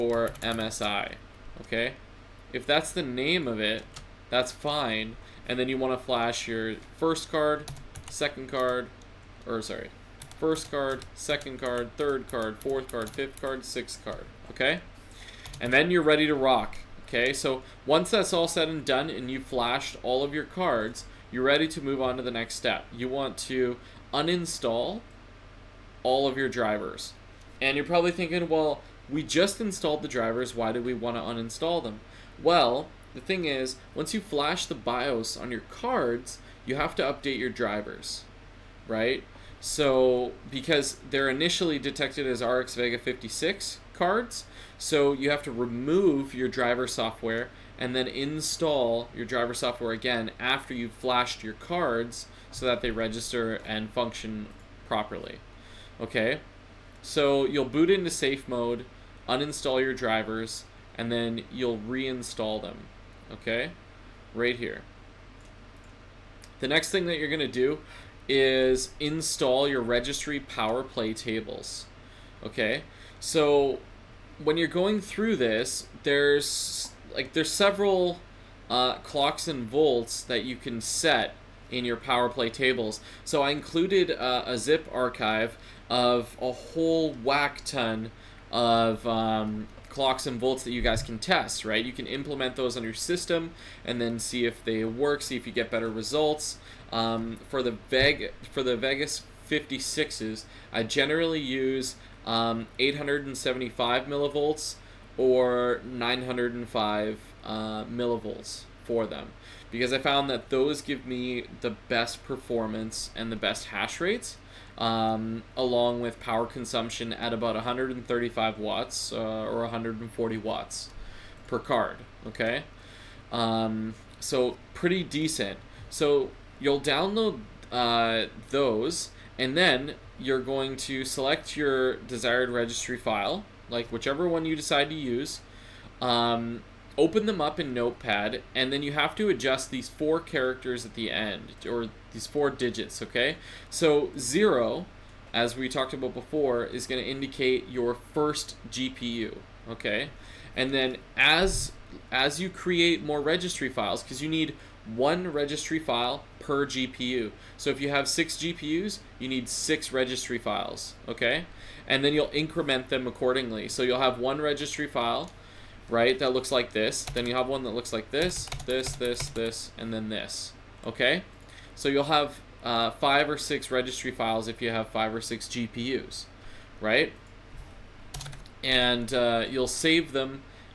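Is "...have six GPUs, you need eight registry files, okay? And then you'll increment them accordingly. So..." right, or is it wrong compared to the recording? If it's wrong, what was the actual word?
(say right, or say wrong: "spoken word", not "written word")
wrong: "six", not "eight".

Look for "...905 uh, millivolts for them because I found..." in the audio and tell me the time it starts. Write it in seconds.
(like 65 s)
105 s.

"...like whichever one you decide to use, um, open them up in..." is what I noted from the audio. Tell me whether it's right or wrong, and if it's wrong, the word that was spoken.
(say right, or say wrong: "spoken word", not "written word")
right.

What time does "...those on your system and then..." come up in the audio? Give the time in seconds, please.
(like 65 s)
92 s.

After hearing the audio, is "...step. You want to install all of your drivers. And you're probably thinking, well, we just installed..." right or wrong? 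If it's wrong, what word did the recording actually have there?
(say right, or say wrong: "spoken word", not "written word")
wrong: "uninstall", not "install".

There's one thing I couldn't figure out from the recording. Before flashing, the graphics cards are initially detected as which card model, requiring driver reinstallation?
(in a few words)
RX Vega 56.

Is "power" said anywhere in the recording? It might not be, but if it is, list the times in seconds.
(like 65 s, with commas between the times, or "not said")
70 s, 81 s, 116 s.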